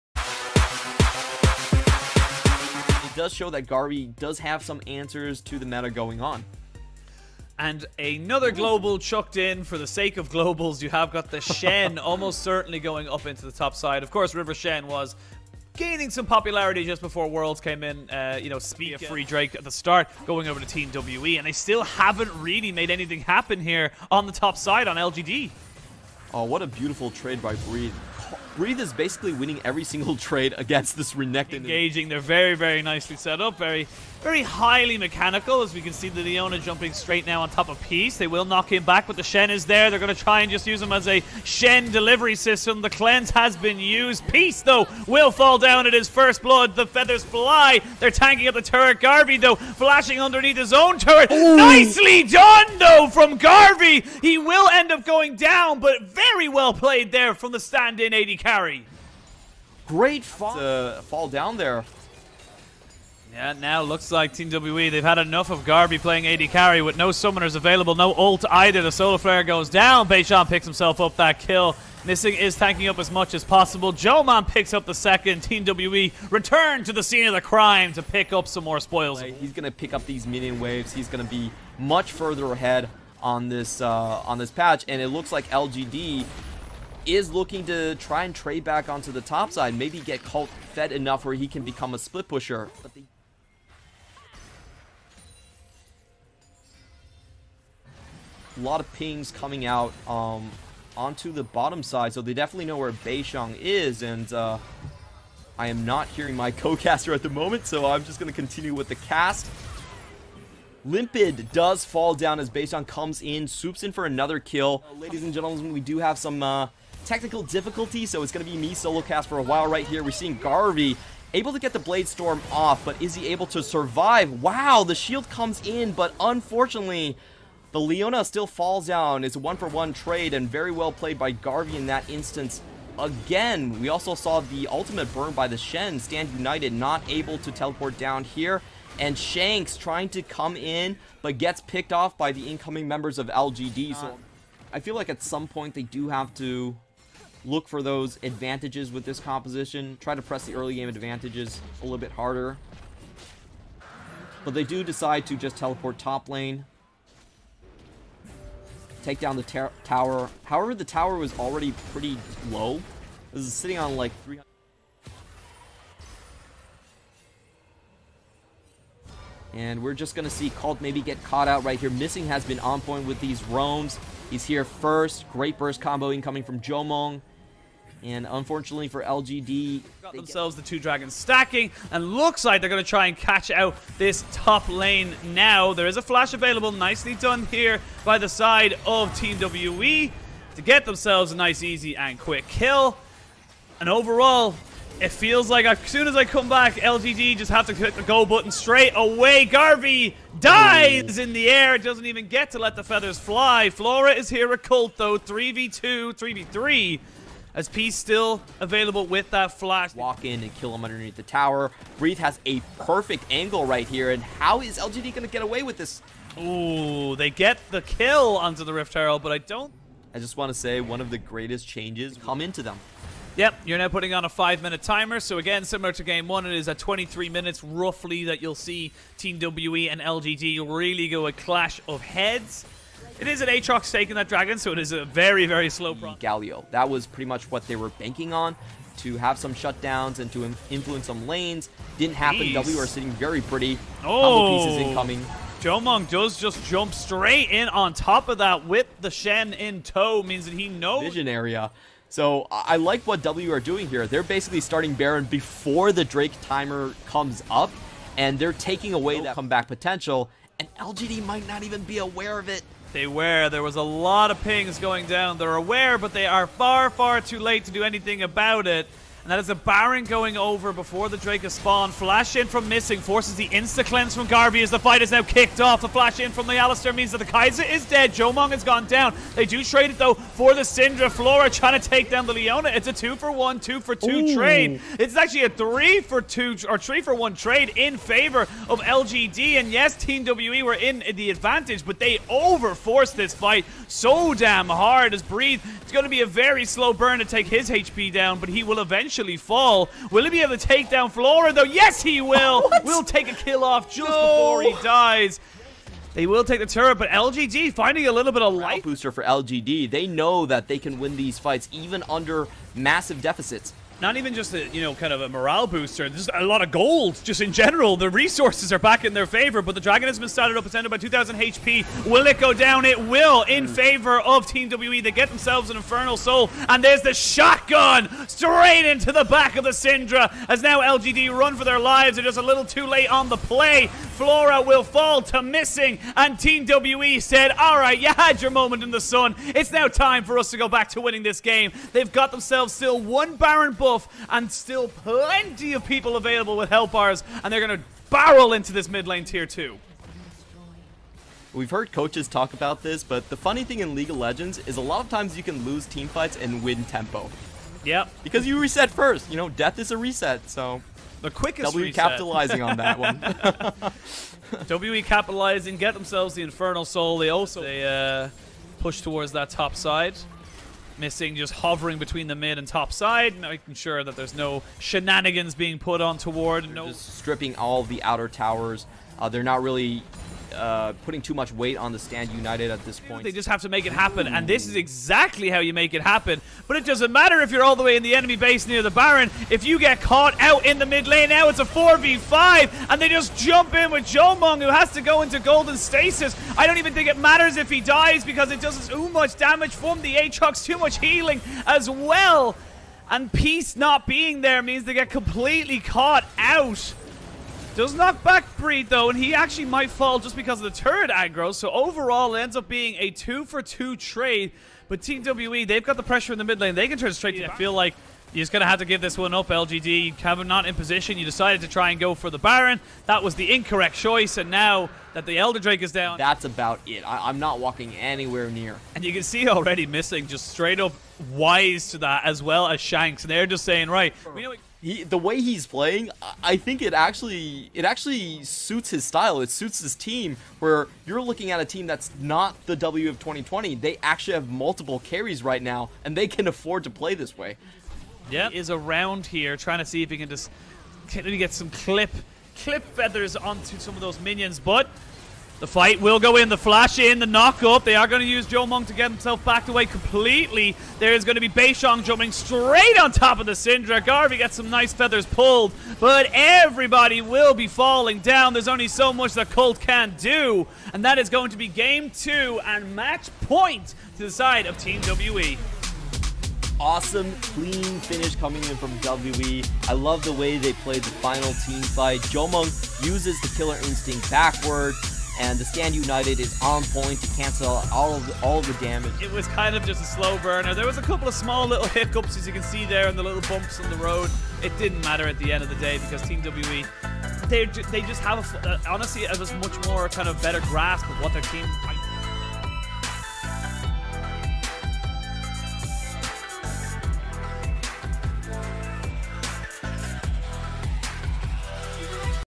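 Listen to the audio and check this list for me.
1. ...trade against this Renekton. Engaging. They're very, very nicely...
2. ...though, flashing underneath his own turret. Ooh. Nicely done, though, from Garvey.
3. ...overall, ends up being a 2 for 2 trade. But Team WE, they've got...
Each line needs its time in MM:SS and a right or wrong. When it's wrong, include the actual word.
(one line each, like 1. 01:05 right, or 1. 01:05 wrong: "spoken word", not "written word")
1. 00:30 right
2. 00:49 right
3. 06:51 right.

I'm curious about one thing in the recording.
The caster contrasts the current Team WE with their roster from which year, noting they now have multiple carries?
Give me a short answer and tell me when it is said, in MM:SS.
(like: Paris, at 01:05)
2020, at 07:23.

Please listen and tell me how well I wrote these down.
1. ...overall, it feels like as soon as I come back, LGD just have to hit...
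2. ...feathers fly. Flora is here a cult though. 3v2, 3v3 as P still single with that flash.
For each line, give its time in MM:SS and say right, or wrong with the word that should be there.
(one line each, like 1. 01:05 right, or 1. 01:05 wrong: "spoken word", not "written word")
1. 03:13 right
2. 03:22 wrong: "available", not "single".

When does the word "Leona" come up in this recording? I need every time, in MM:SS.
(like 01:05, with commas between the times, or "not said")
00:36, 02:07, 04:42.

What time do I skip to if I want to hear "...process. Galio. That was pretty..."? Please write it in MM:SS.
03:55.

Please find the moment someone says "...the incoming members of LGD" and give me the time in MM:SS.
02:22.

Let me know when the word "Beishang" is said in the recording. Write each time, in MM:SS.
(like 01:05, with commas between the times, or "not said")
01:10, 01:42, 01:52, 07:41.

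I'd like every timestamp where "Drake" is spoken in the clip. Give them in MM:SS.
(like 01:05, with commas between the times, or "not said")
00:19, 04:16, 04:31, 07:05.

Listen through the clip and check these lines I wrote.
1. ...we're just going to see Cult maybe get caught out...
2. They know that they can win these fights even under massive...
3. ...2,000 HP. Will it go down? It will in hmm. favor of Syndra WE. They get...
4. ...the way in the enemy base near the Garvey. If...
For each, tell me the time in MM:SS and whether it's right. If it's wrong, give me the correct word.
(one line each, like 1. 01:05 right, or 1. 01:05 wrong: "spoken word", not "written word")
1. 02:49 right
2. 05:09 right
3. 05:20 wrong: "Team", not "Syndra"
4. 06:27 wrong: "Baron", not "Garvey".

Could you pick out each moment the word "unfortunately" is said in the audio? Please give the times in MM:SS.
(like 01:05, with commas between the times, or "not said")
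02:06, 02:58.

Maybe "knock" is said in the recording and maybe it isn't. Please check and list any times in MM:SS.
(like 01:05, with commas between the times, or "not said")
00:38, 06:47, 07:37.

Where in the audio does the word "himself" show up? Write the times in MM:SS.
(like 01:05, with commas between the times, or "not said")
01:10, 07:39.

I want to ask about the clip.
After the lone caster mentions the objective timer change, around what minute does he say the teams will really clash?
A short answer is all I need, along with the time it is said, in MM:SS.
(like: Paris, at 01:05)
23 minutes, at 03:46.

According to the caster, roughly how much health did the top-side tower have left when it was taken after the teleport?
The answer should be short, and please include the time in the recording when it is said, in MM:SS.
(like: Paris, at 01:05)
300, at 02:44.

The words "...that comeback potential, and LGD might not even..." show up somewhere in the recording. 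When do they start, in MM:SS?
04:19.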